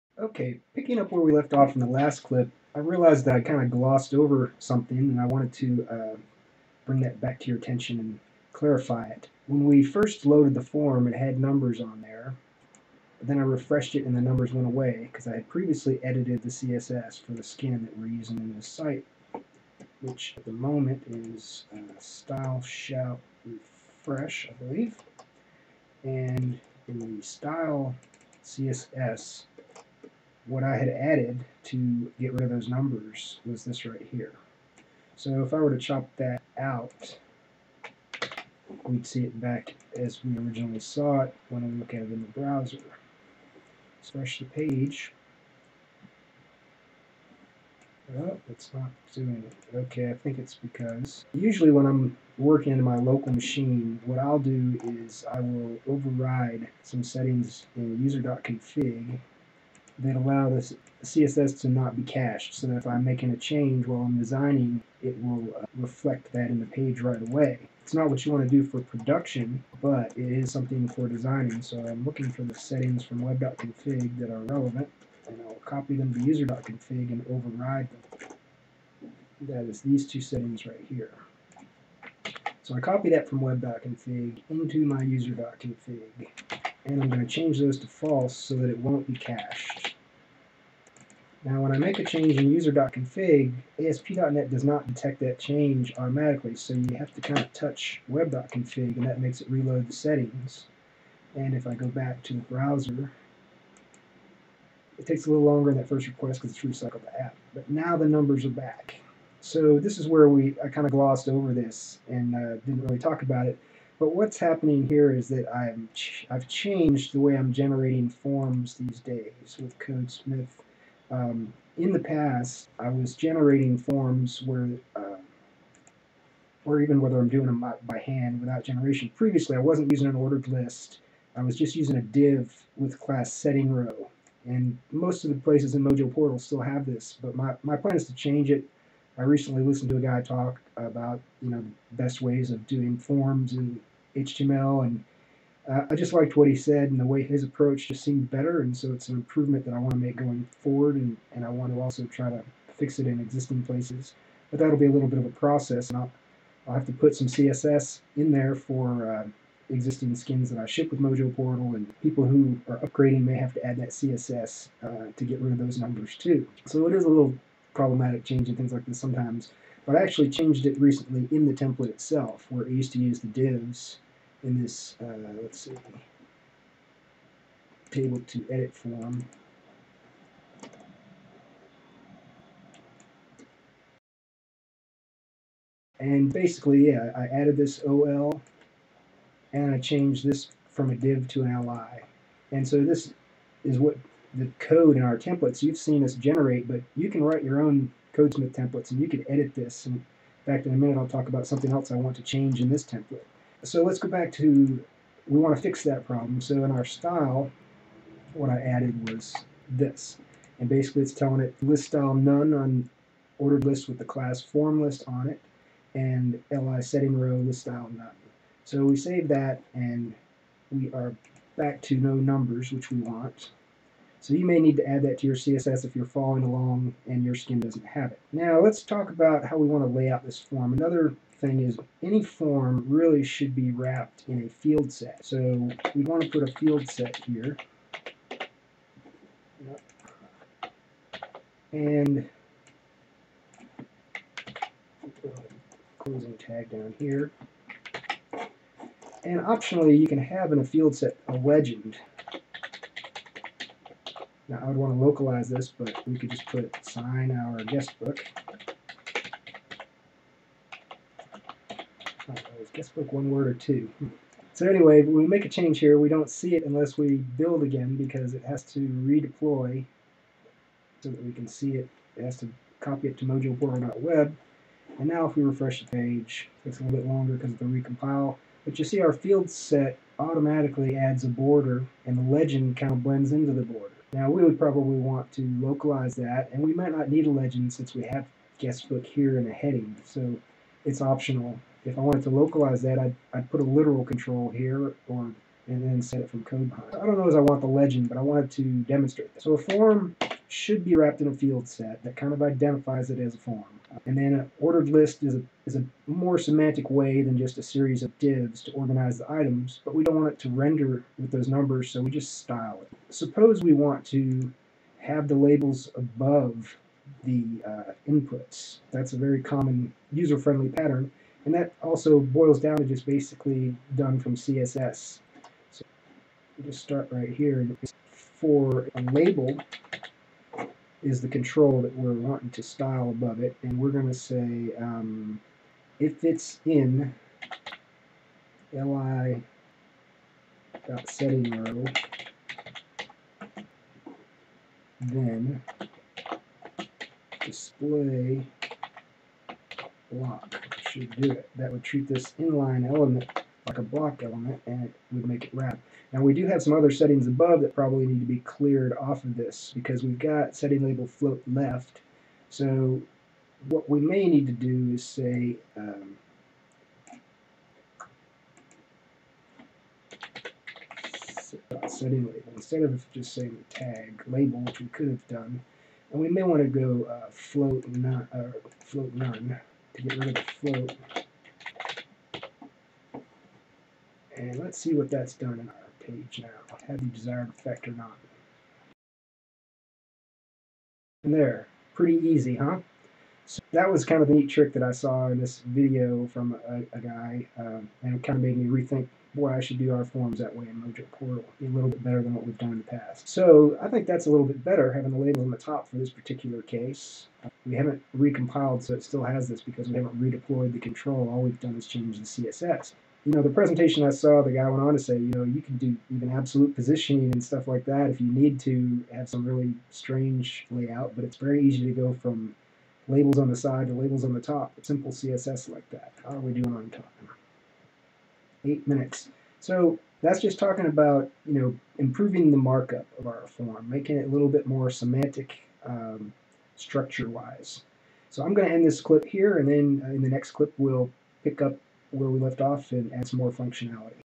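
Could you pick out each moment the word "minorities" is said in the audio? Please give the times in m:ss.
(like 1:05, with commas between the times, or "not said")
not said.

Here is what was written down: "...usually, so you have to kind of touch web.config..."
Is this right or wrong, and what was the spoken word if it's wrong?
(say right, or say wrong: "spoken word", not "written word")
wrong: "automatically", not "usually".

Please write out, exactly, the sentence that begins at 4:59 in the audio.
So a form should be wrapped in a field set that kind of identifies it as a form.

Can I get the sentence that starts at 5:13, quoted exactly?
Suppose we want to have the labels above the uh, inputs.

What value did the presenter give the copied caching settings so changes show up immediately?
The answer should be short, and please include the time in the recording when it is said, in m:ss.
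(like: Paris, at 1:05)
false, at 1:27.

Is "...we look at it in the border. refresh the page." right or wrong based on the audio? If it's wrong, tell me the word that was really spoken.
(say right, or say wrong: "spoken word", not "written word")
wrong: "browser", not "border".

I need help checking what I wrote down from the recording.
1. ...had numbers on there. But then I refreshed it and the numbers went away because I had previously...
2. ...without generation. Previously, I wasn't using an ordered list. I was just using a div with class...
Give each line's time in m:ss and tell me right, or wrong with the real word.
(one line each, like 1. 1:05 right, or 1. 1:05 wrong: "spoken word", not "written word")
1. 0:11 right
2. 2:08 right.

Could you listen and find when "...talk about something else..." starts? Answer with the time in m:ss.
3:21.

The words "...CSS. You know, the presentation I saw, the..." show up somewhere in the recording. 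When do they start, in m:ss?
6:52.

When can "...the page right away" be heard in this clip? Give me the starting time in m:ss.
1:06.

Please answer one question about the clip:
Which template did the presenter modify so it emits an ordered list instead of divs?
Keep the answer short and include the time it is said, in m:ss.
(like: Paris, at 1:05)
table to edit form, at 2:57.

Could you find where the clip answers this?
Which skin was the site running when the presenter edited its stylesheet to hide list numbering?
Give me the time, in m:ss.
0:21.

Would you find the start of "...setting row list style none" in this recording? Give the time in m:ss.
3:36.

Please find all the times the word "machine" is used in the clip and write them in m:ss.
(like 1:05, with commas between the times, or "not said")
0:53.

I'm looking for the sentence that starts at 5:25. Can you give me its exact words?
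So we'll just start right here.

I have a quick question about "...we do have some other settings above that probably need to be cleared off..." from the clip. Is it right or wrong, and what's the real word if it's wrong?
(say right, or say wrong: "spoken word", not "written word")
right.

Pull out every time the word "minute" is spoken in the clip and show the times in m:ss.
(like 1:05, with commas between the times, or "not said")
3:20, 7:08.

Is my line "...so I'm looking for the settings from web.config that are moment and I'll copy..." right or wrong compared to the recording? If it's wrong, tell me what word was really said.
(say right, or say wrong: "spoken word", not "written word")
wrong: "relevant", not "moment".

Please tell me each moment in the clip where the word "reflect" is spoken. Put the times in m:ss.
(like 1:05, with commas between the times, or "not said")
1:05.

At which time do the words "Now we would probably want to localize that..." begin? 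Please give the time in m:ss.
4:44.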